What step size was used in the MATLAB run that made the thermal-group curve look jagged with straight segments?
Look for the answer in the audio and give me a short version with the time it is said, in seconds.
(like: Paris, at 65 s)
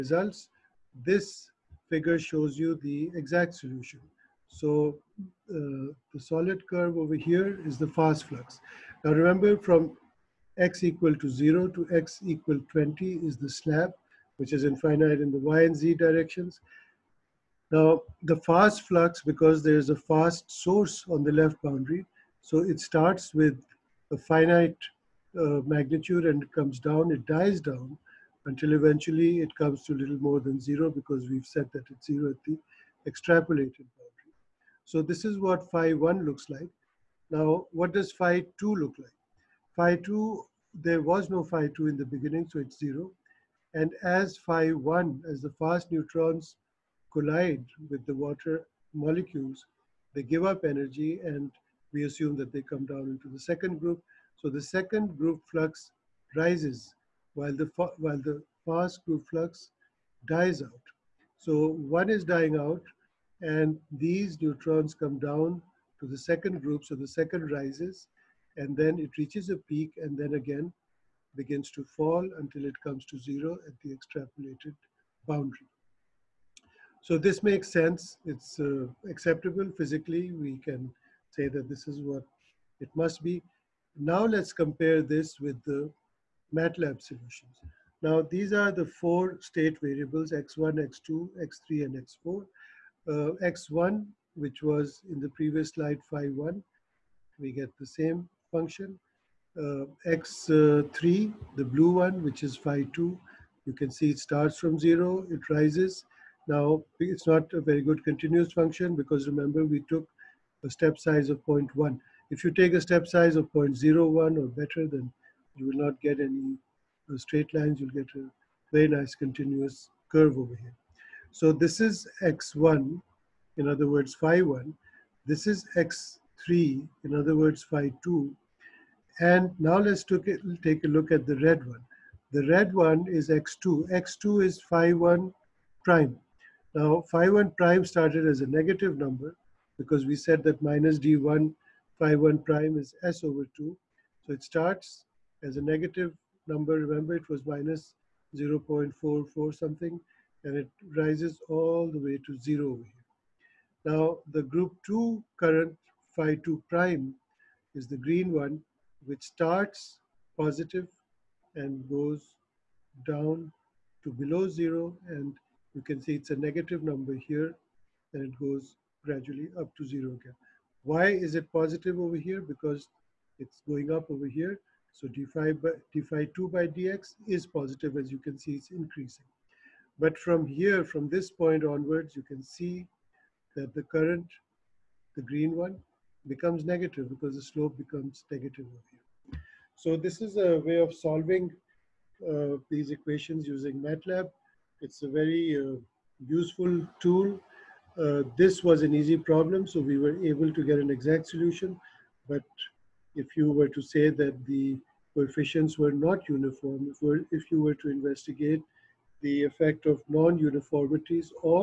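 0.1, at 111 s.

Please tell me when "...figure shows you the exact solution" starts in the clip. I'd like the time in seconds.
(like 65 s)
1 s.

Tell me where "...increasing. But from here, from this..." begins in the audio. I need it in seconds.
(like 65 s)
178 s.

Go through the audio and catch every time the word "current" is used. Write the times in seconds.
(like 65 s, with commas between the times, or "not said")
155 s, 183 s.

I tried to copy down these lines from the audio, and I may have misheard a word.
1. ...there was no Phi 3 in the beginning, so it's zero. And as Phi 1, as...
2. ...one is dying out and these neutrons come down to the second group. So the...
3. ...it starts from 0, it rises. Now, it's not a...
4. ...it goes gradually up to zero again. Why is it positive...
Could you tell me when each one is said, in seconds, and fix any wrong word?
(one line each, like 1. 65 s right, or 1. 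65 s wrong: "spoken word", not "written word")
1. 40 s wrong: "2", not "3"
2. 61 s right
3. 104 s right
4. 168 s right.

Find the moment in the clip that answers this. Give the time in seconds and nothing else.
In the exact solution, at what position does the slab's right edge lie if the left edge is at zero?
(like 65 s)
12 s.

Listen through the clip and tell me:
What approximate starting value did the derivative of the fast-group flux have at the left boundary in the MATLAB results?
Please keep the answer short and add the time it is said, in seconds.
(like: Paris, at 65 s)
-0.44, at 147 s.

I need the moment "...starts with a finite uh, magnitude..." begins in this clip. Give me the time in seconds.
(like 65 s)
22 s.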